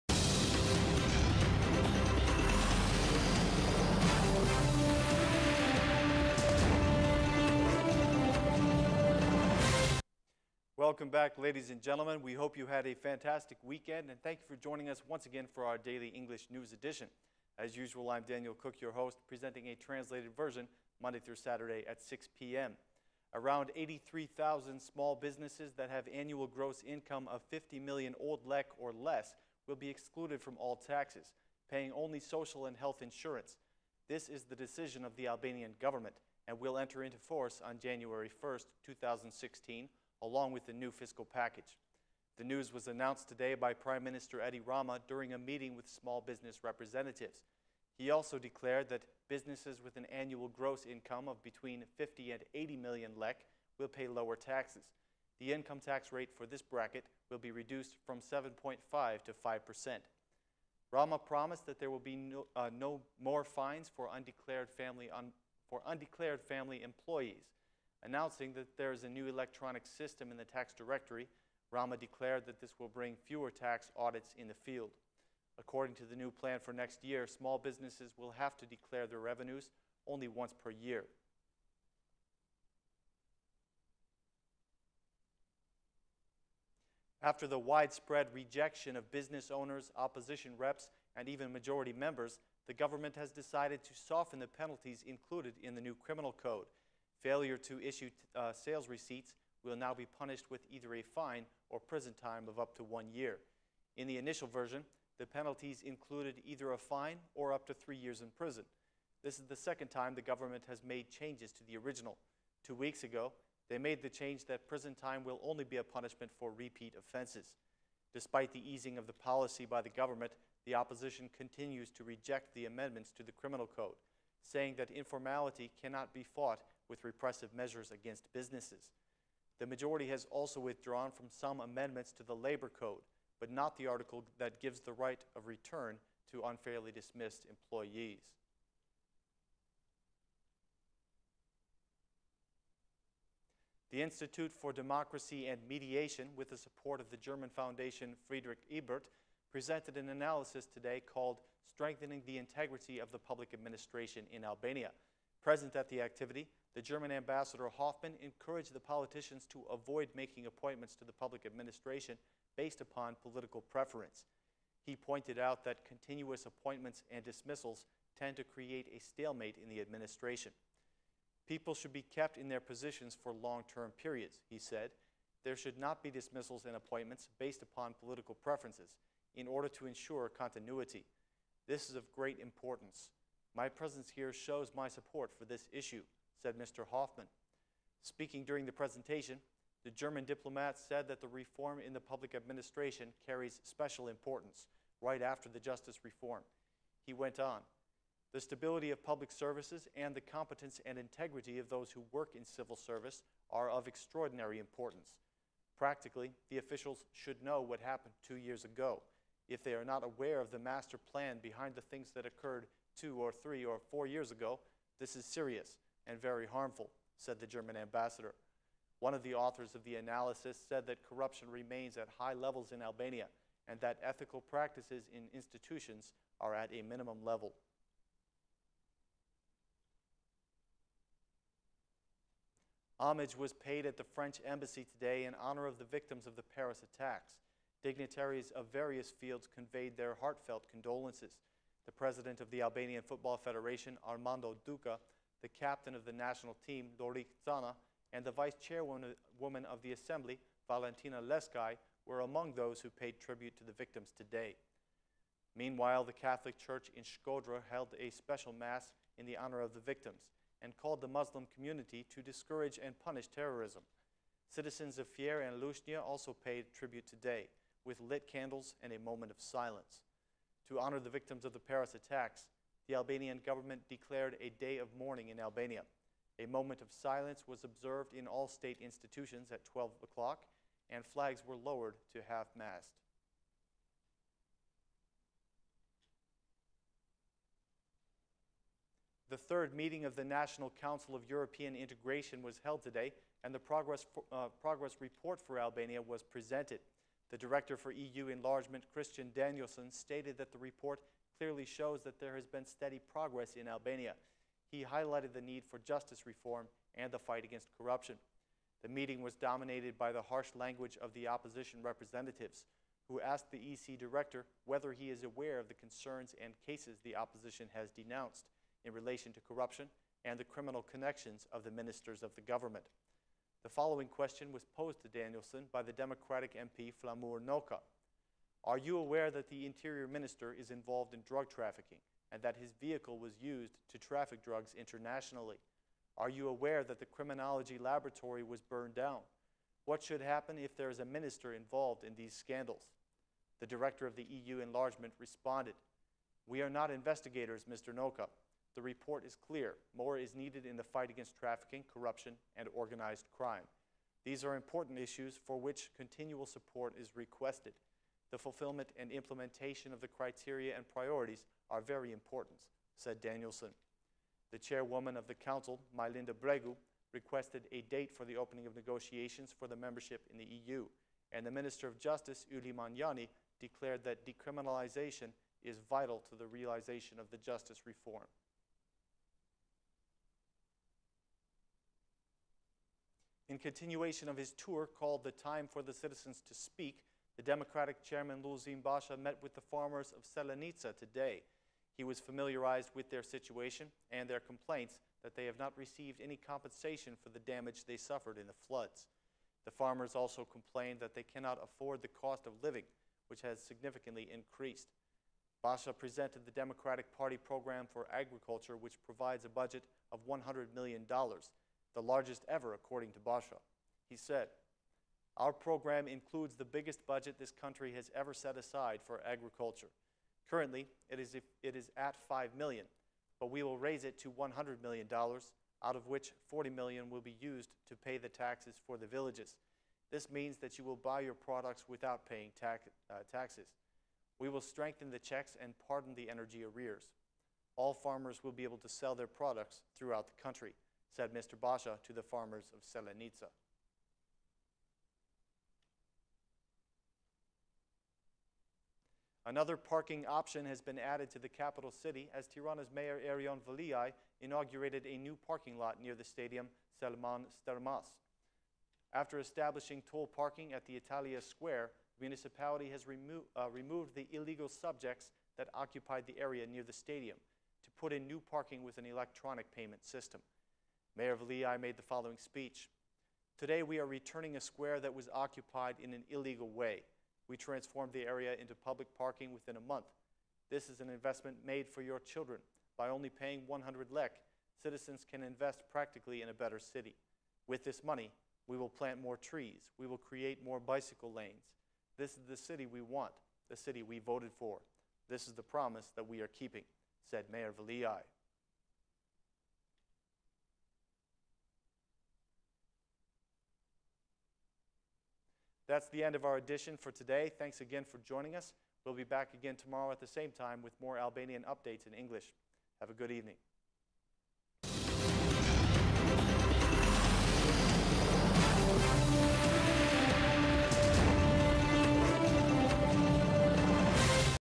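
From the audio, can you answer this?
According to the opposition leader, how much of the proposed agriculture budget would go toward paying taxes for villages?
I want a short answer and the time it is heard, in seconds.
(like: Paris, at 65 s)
$40 million, at 426 s.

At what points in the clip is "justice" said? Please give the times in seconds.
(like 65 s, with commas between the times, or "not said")
195 s, 305 s, 371 s, 377 s.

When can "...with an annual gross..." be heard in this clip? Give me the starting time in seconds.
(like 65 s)
49 s.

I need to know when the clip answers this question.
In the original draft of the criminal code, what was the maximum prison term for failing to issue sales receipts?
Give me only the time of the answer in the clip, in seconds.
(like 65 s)
107 s.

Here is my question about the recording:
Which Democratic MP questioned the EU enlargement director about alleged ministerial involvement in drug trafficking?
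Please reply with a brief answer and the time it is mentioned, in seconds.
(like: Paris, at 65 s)
Flamur Noka, at 327 s.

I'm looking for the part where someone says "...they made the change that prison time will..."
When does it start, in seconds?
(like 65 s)
113 s.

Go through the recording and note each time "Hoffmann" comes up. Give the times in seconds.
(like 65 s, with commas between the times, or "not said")
157 s, 186 s.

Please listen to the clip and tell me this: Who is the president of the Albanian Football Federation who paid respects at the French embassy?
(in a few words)
Armando Duka.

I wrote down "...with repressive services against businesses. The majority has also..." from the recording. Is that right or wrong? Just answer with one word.
wrong.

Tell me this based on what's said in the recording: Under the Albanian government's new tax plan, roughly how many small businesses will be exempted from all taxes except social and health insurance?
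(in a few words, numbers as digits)
83,000.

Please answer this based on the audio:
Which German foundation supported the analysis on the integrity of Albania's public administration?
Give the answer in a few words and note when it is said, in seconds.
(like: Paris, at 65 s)
Friedrich Ebert, at 148 s.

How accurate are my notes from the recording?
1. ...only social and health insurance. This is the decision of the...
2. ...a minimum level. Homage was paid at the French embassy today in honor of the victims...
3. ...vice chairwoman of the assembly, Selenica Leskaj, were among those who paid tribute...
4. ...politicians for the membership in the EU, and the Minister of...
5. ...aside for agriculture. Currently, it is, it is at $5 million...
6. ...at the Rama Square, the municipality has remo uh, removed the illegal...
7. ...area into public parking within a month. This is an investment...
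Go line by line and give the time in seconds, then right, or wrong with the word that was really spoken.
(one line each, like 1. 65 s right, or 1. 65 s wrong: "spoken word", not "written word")
1. 31 s right
2. 226 s right
3. 248 s wrong: "Valentina", not "Selenica"
4. 368 s wrong: "negotiations", not "politicians"
5. 418 s right
6. 460 s wrong: "Italia", not "Rama"
7. 478 s right.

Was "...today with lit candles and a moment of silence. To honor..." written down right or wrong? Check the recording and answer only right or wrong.
right.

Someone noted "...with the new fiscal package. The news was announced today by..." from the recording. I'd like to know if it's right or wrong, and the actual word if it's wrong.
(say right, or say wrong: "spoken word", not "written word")
right.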